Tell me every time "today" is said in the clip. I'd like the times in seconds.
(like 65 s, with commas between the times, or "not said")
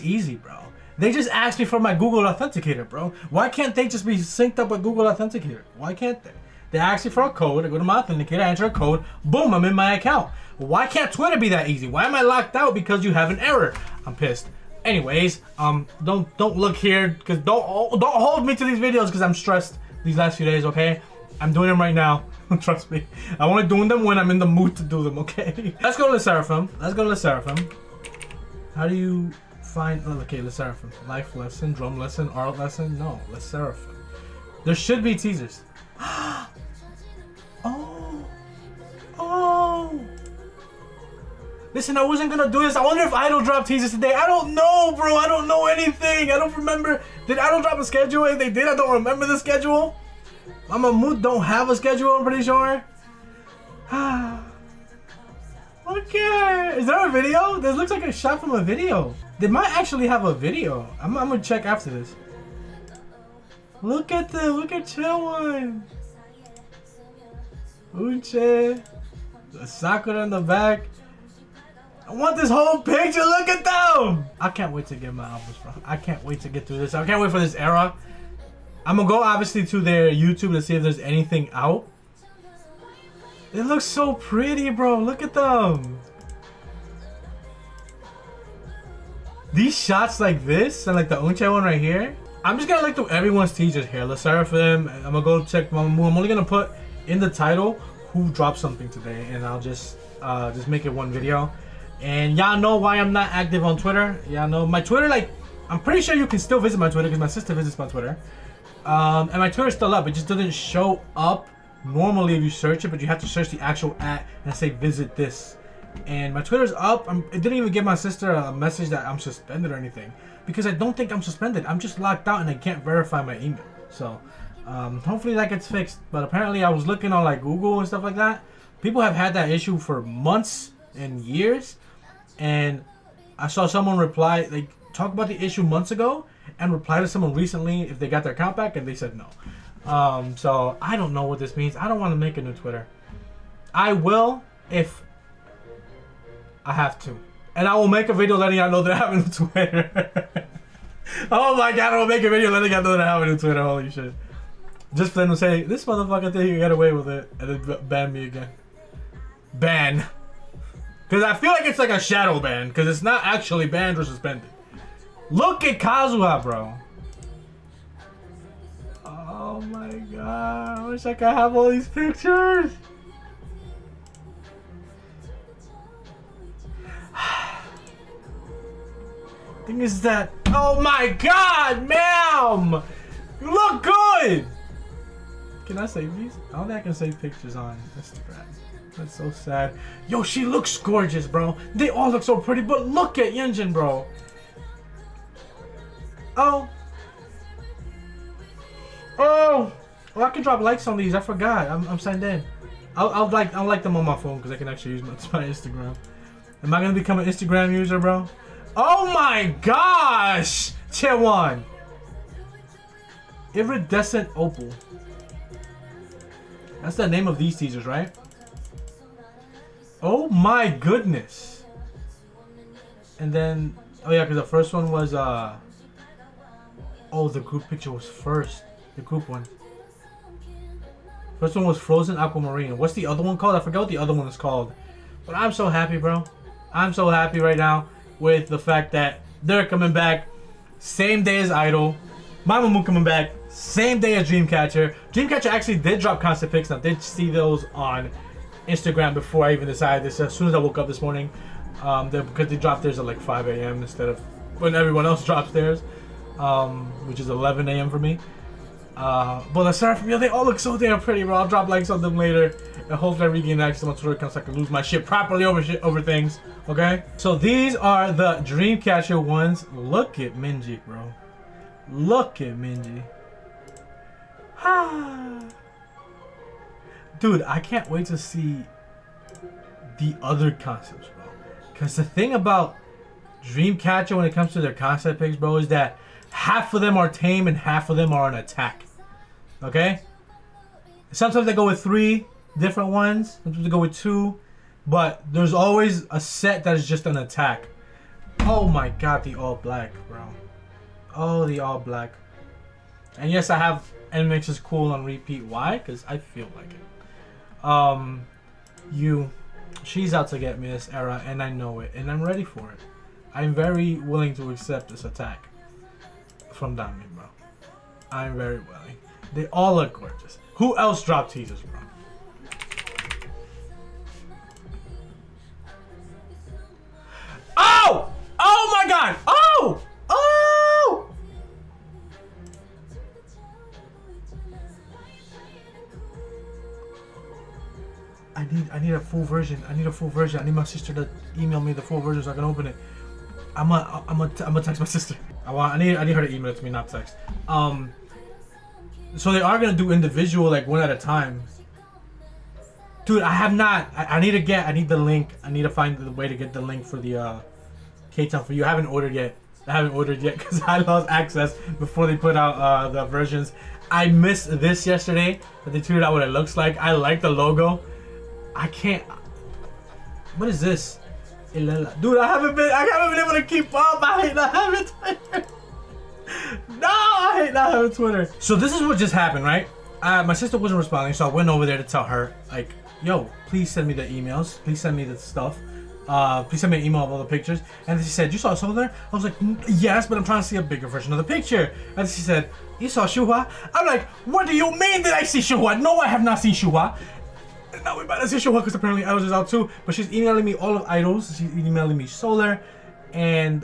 43 s, 98 s.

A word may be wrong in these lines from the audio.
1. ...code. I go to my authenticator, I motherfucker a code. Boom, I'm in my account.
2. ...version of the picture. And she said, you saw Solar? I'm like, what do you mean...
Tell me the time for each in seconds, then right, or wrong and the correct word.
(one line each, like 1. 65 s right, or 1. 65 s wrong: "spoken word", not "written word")
1. 7 s wrong: "enter", not "motherfucker"
2. 390 s wrong: "Shuhua", not "Solar".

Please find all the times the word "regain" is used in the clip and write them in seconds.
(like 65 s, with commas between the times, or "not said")
263 s.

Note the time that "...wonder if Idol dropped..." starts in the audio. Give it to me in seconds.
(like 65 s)
42 s.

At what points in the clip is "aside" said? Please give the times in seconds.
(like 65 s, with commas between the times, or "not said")
259 s.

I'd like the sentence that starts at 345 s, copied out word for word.
I want I need I need her to email it to me, not text.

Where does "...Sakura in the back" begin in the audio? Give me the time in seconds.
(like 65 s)
69 s.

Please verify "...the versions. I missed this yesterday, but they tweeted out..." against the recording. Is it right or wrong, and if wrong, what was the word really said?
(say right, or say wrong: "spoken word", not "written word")
right.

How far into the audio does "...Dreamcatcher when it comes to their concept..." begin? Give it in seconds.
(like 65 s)
283 s.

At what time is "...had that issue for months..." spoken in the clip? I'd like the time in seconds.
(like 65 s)
129 s.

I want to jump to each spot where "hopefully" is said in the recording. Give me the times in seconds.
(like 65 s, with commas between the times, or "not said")
125 s, 262 s.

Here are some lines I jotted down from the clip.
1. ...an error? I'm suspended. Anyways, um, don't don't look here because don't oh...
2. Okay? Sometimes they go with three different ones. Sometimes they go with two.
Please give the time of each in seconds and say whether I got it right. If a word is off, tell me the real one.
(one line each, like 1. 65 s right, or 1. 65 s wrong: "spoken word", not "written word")
1. 13 s wrong: "pissed", not "suspended"
2. 289 s right.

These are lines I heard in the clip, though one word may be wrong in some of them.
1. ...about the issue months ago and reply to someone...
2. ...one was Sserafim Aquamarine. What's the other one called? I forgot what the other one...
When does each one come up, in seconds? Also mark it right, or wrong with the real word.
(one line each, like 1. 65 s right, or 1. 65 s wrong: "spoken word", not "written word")
1. 135 s right
2. 231 s wrong: "Frozen", not "Sserafim".